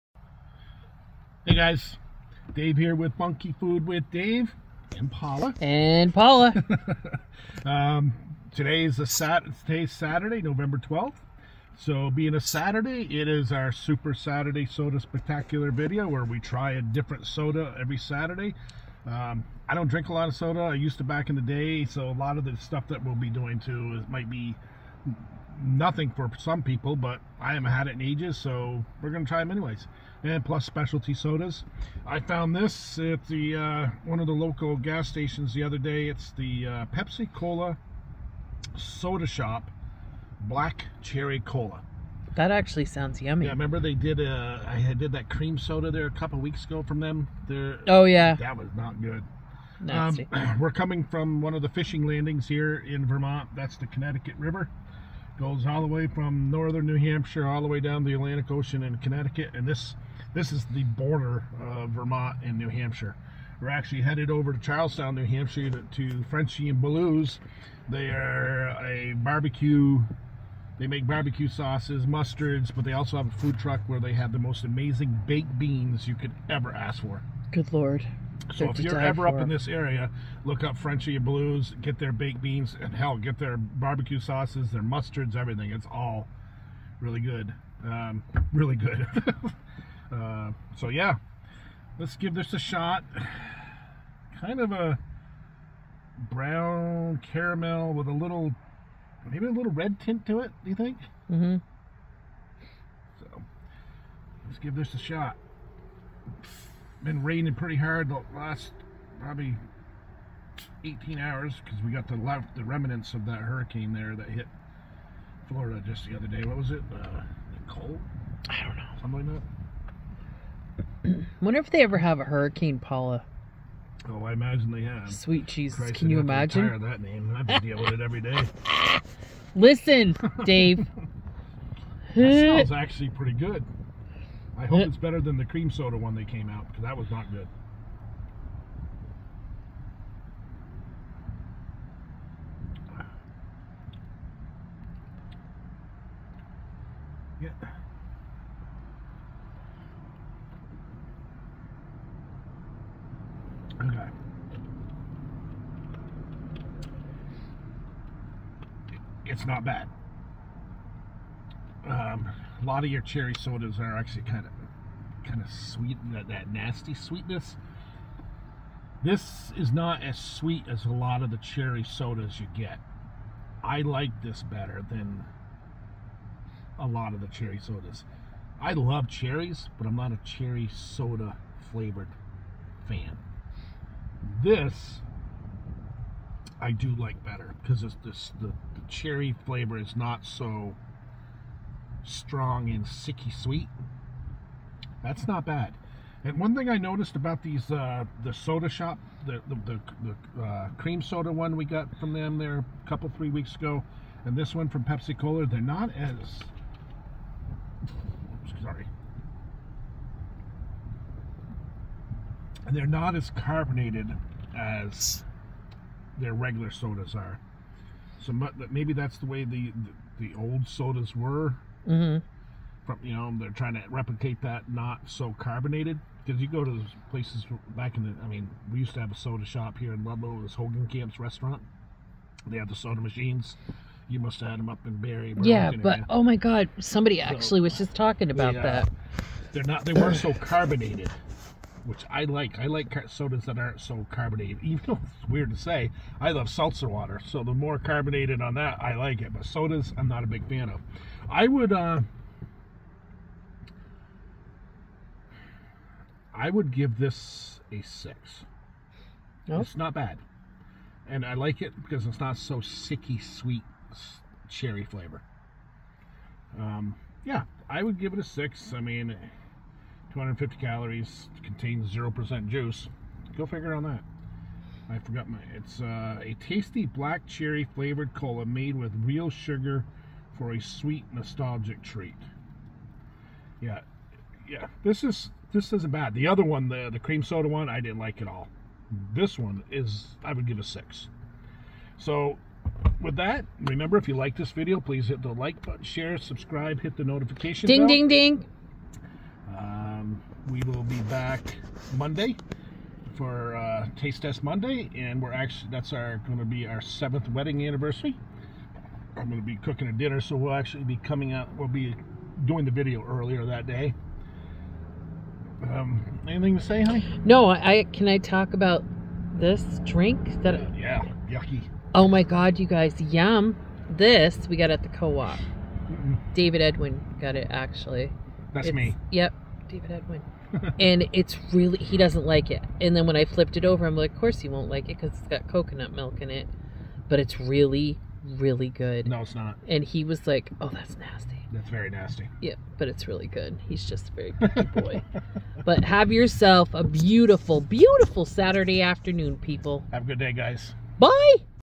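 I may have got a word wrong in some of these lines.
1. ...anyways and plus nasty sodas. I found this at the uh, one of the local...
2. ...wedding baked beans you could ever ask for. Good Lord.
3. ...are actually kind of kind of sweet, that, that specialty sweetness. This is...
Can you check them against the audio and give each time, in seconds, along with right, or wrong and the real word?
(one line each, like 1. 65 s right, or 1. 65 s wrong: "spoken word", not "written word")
1. 29 s wrong: "specialty", not "nasty"
2. 74 s wrong: "amazing", not "wedding"
3. 163 s wrong: "nasty", not "specialty".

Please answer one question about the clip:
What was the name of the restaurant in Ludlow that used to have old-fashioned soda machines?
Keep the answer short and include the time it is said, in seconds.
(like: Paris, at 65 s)
Hogan Camp's, at 230 s.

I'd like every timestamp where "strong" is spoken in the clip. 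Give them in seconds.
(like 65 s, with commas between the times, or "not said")
192 s.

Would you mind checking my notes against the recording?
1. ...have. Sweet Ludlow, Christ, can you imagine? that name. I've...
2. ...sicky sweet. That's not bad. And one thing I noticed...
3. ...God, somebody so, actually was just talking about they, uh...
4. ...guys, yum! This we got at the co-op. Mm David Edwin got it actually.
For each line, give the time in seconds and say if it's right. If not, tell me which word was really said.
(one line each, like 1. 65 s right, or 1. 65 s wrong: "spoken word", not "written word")
1. 124 s wrong: "Jesus", not "Ludlow"
2. 192 s right
3. 236 s right
4. 322 s right.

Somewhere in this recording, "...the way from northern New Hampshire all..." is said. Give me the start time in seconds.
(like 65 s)
55 s.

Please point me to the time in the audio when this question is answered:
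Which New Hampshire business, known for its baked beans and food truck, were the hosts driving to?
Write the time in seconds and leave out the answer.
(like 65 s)
66 s.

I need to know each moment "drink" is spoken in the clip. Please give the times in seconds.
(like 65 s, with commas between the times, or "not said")
19 s, 319 s.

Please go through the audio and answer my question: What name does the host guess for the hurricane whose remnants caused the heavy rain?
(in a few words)
Nicole.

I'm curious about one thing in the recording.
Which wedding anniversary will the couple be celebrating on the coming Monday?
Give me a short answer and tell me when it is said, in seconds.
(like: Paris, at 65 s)
seventh, at 306 s.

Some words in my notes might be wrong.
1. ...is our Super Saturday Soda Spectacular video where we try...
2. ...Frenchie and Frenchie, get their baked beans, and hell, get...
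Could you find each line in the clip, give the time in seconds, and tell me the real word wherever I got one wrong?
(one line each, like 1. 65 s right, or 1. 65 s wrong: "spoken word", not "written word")
1. 13 s right
2. 80 s wrong: "Blues", not "Frenchie".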